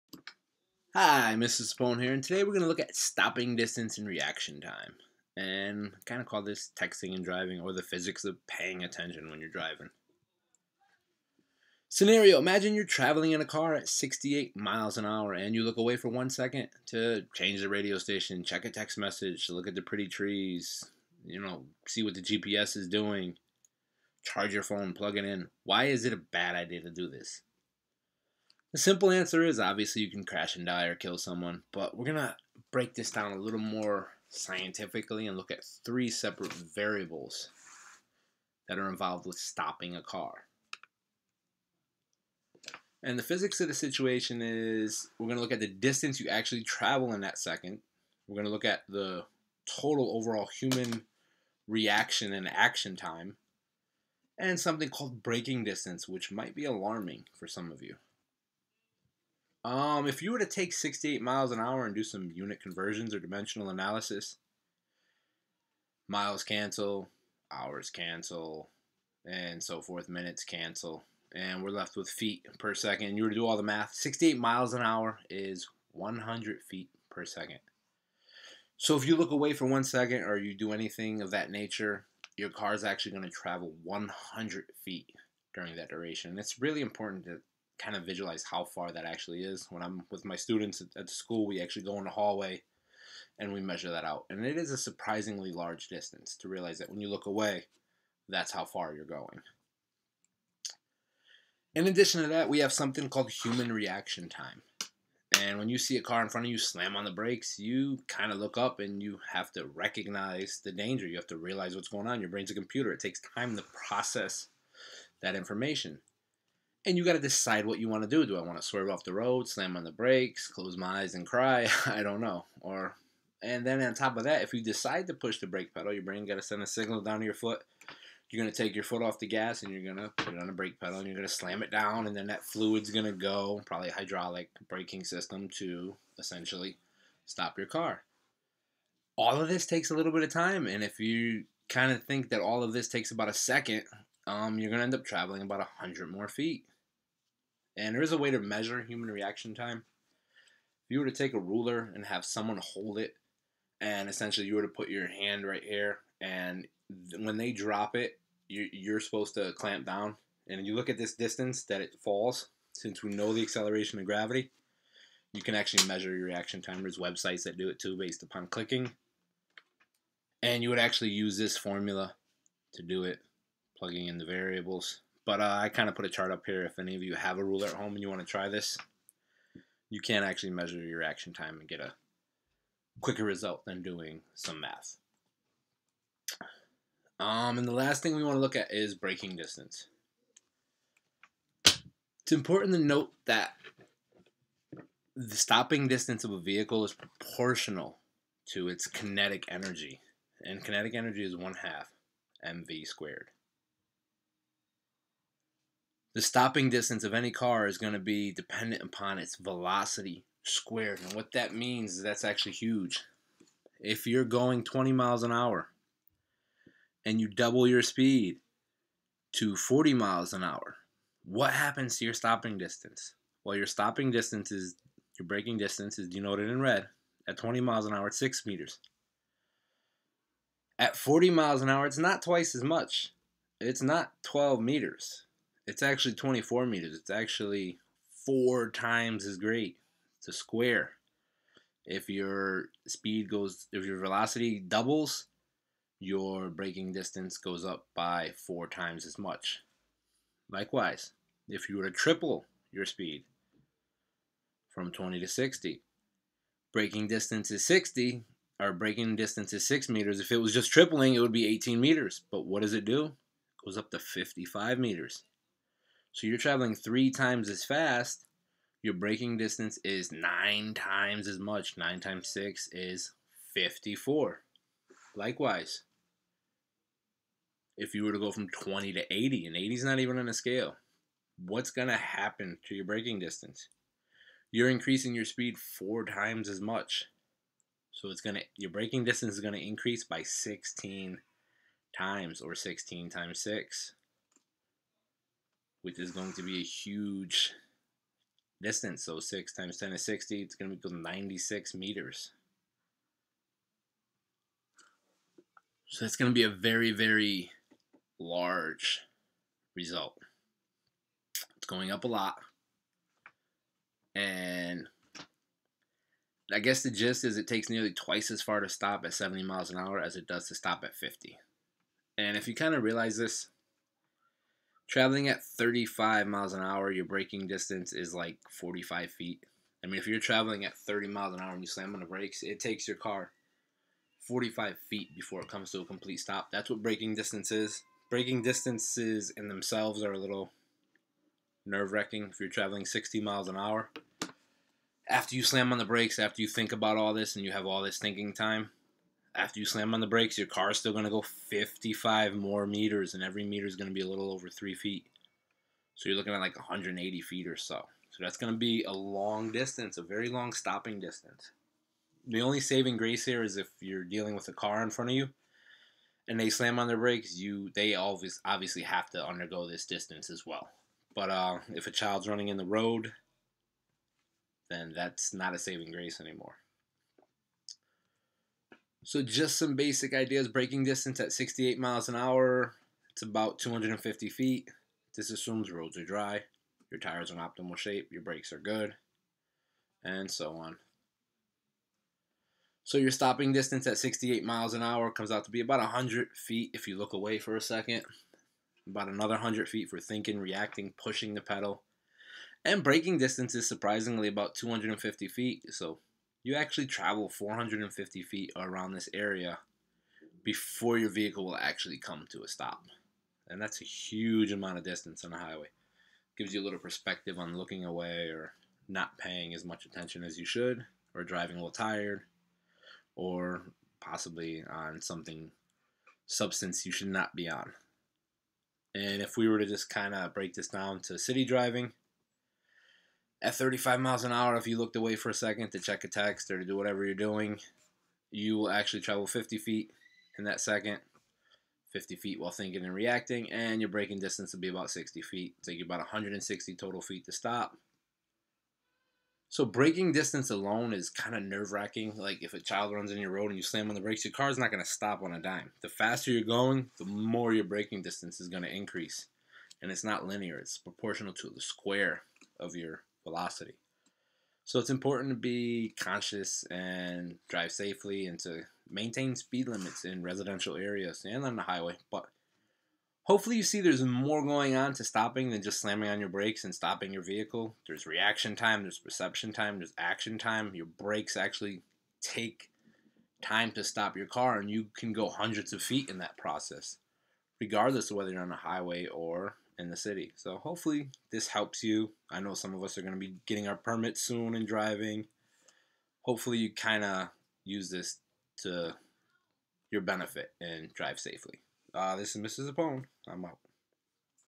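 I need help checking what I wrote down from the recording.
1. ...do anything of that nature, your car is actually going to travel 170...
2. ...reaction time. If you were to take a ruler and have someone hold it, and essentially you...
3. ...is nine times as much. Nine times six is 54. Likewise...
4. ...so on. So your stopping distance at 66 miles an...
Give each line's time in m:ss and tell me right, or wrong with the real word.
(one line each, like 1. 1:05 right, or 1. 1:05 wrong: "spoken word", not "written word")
1. 1:20 wrong: "100", not "170"
2. 2:29 right
3. 4:29 right
4. 6:30 wrong: "68", not "66".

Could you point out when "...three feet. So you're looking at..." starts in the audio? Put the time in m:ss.
5:54.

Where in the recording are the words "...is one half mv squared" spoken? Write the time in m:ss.
3:21.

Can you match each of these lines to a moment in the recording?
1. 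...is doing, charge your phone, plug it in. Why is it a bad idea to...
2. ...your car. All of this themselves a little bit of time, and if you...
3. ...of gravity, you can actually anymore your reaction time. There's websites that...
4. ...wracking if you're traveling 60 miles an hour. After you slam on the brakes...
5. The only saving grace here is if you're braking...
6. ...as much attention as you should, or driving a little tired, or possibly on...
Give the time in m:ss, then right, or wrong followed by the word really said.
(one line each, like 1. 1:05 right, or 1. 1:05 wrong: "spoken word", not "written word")
1. 0:22 right
2. 2:17 wrong: "takes", not "themselves"
3. 2:43 wrong: "measure", not "anymore"
4. 5:41 right
5. 6:02 wrong: "dealing", not "braking"
6. 6:59 right.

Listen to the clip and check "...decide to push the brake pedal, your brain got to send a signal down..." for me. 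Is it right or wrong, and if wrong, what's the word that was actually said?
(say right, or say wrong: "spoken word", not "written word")
right.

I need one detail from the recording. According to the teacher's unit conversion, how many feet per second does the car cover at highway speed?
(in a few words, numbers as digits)
100 feet per second.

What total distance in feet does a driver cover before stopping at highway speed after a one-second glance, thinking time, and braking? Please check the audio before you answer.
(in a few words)
450 feet.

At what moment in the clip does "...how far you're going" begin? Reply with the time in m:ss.
1:38.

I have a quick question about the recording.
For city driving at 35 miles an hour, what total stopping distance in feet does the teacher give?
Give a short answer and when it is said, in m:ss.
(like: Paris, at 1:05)
160 feet, at 7:25.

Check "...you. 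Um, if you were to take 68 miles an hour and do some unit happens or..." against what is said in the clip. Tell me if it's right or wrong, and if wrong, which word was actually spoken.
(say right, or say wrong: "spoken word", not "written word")
wrong: "conversions", not "happens".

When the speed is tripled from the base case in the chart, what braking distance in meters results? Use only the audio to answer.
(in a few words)
55 meters.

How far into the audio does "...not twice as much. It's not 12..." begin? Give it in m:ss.
3:51.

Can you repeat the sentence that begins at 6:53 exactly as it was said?
And that's a huge amount of distance on a highway.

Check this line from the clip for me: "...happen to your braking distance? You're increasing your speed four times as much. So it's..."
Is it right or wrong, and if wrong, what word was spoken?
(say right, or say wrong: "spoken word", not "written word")
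right.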